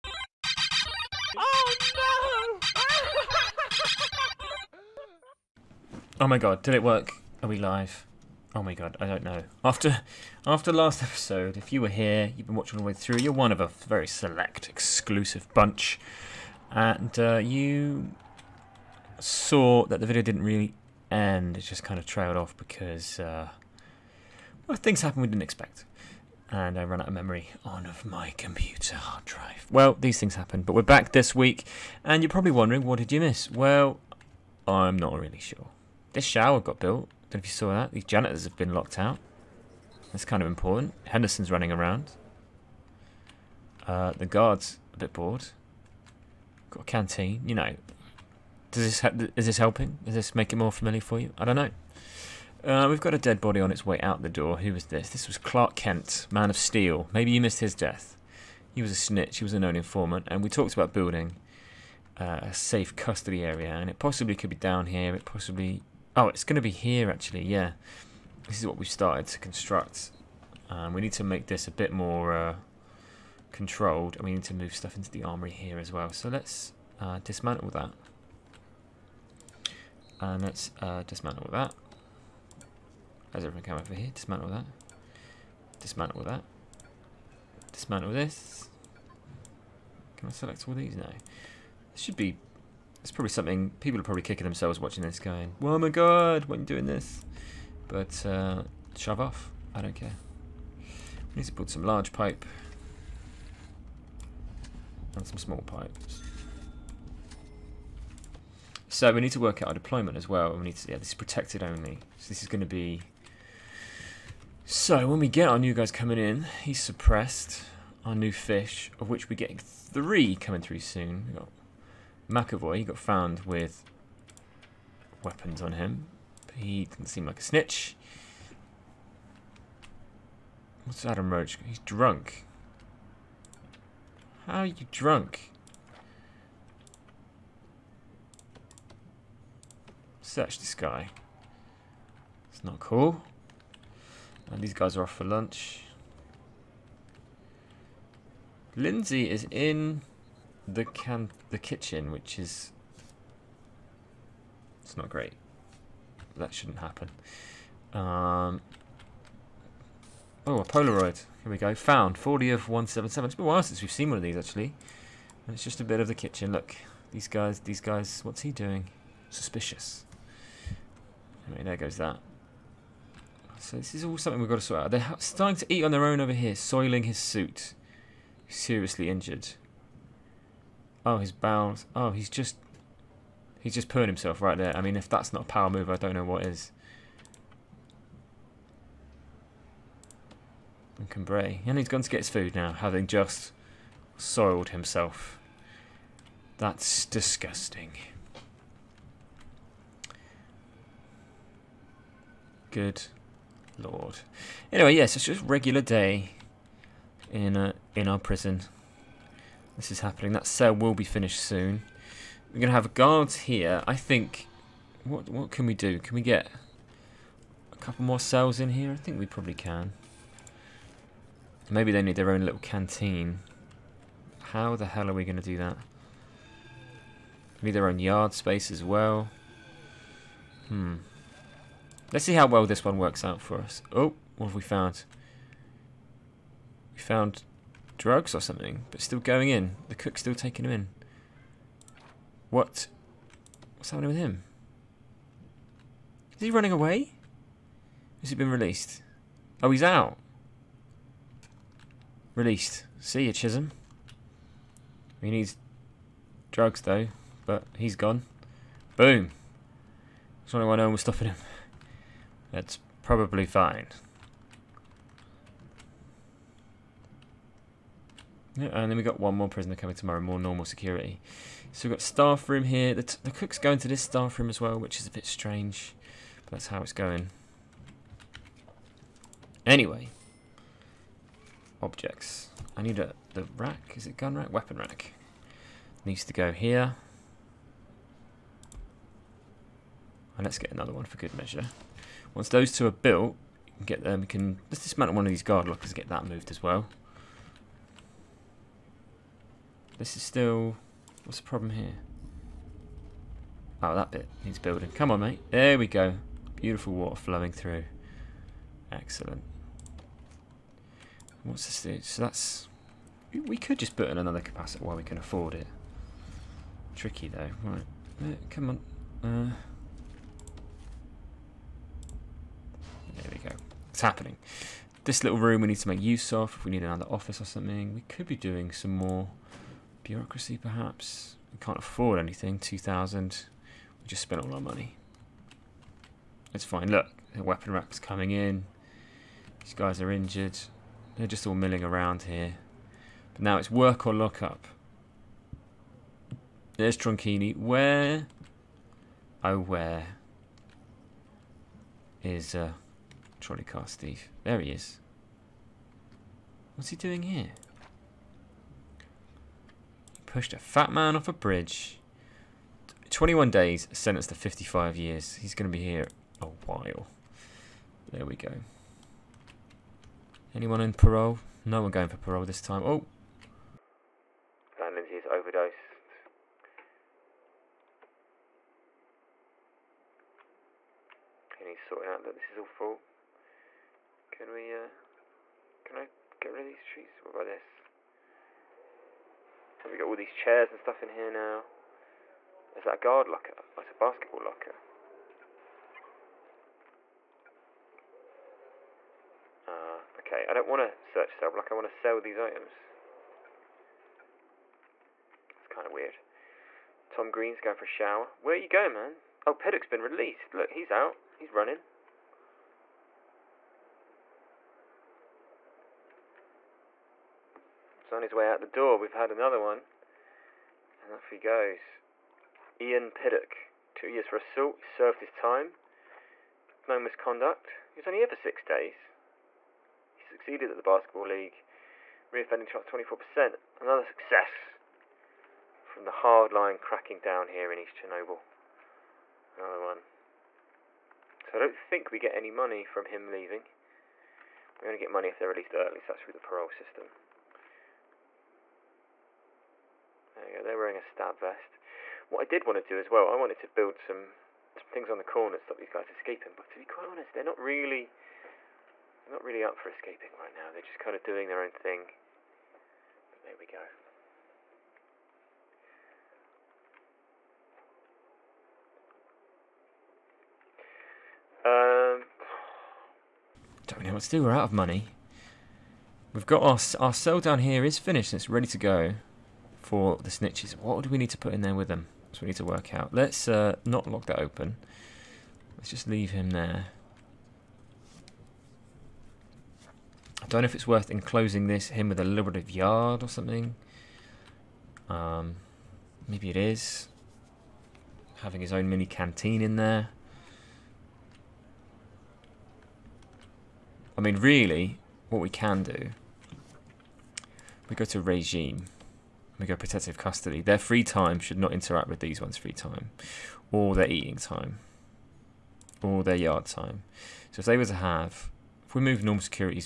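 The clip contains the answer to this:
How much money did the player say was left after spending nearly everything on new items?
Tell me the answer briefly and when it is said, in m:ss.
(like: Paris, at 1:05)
2,000, at 5:32.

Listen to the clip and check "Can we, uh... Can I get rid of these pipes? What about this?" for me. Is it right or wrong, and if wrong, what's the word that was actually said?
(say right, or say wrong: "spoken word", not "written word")
wrong: "trees", not "pipes".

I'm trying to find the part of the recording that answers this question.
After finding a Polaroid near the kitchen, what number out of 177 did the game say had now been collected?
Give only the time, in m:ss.
2:42.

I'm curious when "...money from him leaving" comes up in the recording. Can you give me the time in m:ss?
7:22.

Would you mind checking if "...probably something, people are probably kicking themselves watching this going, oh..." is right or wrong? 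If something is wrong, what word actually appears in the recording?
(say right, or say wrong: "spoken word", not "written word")
right.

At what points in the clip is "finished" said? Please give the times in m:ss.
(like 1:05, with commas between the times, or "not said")
3:31, 7:57.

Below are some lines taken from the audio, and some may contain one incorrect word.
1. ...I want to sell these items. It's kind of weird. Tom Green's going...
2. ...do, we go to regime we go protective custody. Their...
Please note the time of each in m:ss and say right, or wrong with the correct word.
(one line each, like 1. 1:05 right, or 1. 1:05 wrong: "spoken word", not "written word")
1. 6:41 right
2. 8:25 right.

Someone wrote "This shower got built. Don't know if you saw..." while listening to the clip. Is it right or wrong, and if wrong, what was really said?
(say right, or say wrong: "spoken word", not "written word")
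right.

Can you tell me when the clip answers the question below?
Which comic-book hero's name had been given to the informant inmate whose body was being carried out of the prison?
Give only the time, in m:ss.
0:55.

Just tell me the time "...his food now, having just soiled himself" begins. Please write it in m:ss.
3:12.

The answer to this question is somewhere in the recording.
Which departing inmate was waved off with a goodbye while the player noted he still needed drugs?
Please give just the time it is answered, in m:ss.
4:13.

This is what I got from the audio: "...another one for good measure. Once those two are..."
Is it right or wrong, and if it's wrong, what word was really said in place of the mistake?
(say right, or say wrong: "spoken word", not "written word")
right.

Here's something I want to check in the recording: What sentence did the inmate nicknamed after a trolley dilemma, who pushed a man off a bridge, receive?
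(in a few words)
55 years.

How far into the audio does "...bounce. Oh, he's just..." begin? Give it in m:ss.
3:01.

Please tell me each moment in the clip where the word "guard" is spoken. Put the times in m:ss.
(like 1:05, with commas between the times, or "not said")
0:44, 3:32, 4:55, 6:32.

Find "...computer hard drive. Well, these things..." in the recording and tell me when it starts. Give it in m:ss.
0:28.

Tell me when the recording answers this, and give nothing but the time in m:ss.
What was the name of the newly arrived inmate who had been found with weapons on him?
2:02.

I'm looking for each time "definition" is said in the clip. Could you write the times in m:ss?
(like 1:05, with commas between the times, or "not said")
not said.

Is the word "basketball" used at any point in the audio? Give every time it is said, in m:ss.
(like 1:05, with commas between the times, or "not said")
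6:33, 7:10.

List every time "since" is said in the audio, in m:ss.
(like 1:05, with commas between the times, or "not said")
2:43.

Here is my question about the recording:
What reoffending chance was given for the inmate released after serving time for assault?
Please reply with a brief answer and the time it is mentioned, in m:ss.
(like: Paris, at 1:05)
24%, at 7:12.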